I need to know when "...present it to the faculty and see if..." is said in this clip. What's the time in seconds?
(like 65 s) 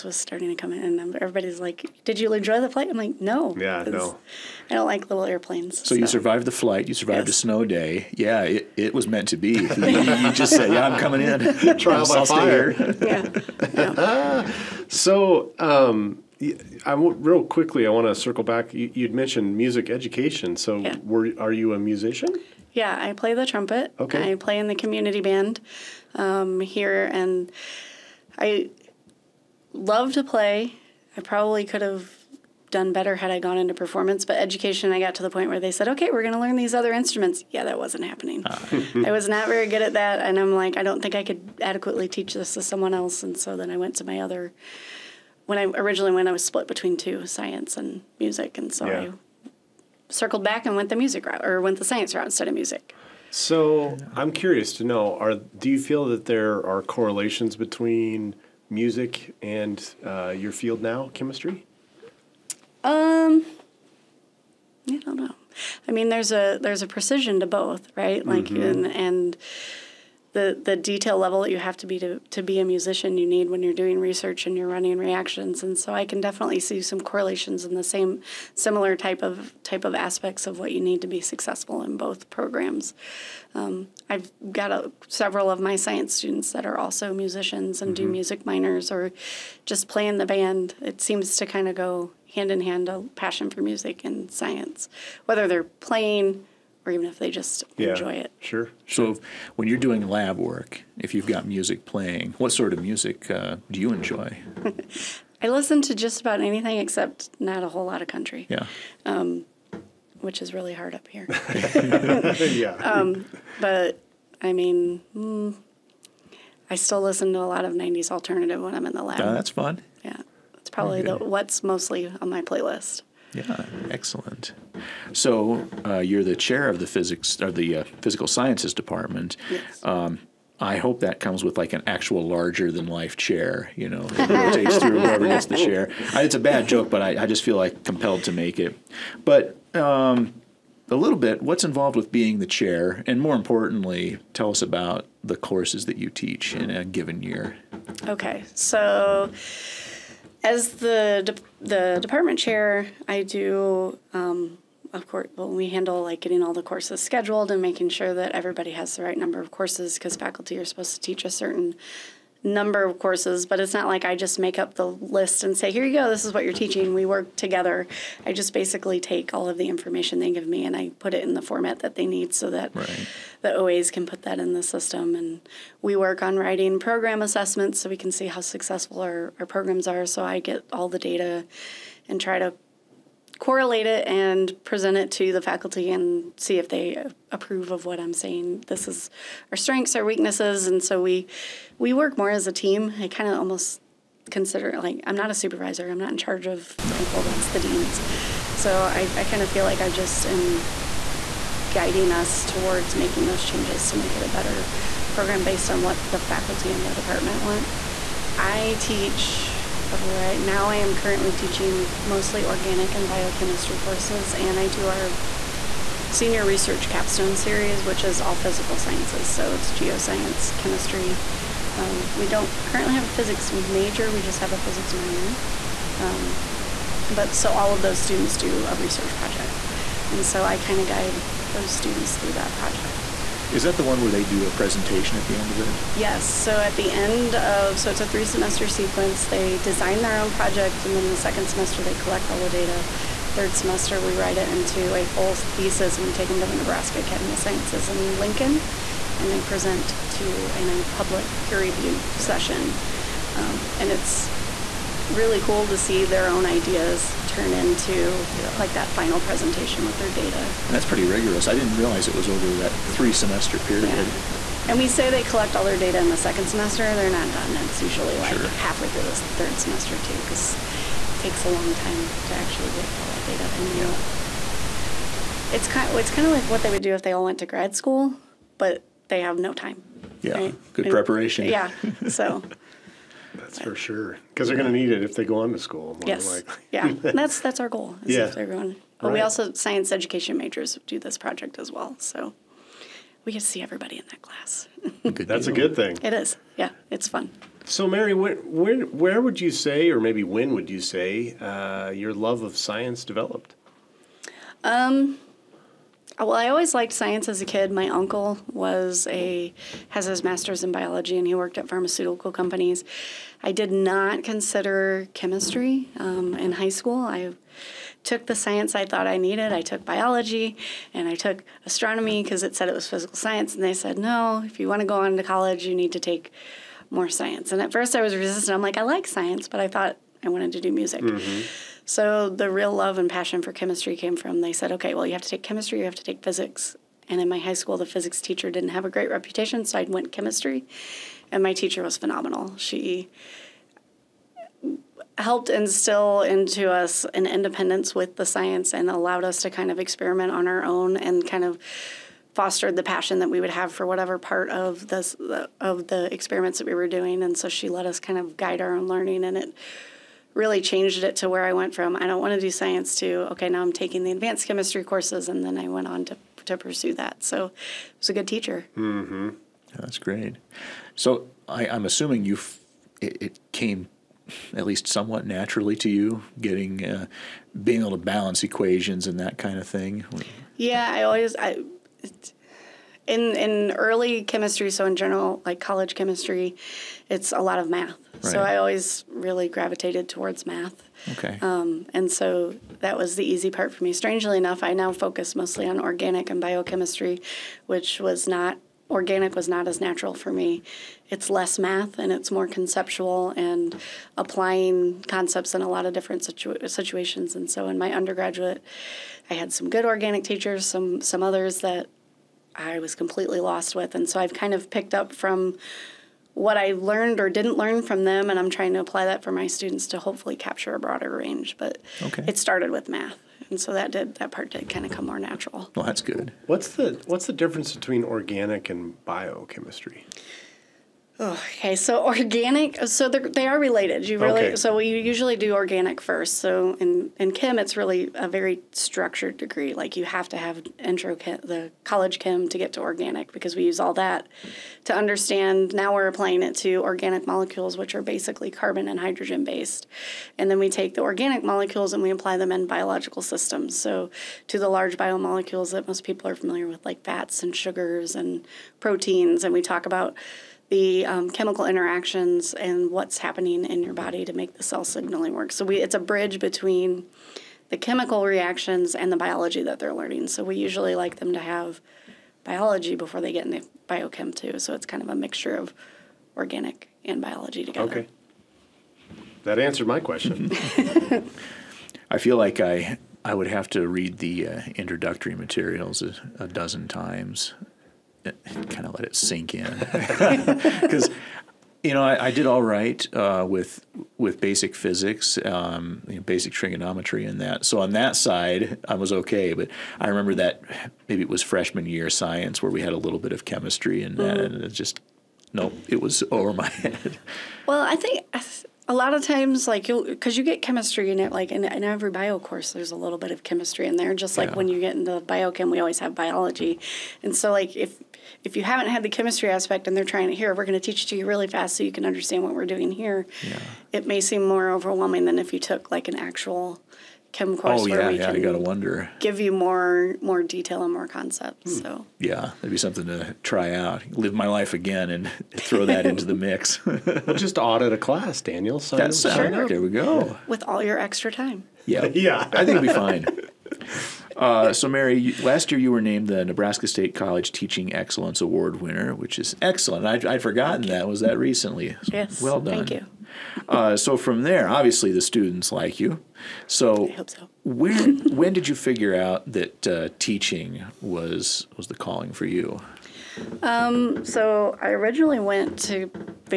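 184 s.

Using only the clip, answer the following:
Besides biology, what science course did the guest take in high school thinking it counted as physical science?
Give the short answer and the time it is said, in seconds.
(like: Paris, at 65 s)
Astronomy, at 321 s.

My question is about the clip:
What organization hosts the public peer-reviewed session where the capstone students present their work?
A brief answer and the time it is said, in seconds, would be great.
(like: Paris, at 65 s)
Nebraska Academy of Sciences, at 246 s.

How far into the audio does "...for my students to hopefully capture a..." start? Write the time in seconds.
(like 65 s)
419 s.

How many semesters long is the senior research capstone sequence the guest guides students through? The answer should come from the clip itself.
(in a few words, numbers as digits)
3.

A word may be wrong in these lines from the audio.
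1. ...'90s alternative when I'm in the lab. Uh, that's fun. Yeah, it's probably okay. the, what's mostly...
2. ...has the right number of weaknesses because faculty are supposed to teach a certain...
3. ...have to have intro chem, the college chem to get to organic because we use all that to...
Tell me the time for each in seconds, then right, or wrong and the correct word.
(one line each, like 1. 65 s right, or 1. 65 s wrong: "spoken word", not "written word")
1. 117 s right
2. 158 s wrong: "courses", not "weaknesses"
3. 440 s right.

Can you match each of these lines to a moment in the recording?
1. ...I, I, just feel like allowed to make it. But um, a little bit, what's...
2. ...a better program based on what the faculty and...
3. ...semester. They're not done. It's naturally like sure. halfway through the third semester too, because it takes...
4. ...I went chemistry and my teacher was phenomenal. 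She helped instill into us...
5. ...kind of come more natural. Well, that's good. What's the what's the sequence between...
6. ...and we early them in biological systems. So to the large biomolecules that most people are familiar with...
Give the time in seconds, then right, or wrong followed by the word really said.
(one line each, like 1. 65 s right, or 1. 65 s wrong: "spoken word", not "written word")
1. 137 s wrong: "compelled", not "allowed"
2. 204 s right
3. 266 s wrong: "usually", not "naturally"
4. 339 s right
5. 424 s wrong: "difference", not "sequence"
6. 451 s wrong: "apply", not "early".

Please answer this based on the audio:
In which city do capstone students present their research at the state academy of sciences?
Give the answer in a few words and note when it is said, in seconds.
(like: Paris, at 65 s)
Lincoln, at 248 s.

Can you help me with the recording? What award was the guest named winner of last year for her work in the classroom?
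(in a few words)
Nebraska State College Teaching Excellence Award.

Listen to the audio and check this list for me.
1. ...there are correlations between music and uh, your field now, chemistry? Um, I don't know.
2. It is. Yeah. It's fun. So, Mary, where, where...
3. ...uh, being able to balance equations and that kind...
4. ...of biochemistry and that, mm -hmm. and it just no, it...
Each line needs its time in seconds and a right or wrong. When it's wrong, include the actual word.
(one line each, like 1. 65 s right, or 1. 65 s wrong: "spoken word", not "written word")
1. 56 s right
2. 296 s right
3. 376 s right
4. 503 s wrong: "chemistry", not "biochemistry".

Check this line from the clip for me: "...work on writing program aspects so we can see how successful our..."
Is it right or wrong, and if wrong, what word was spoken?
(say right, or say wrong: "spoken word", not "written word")
wrong: "assessments", not "aspects".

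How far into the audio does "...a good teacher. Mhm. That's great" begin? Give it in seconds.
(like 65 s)
368 s.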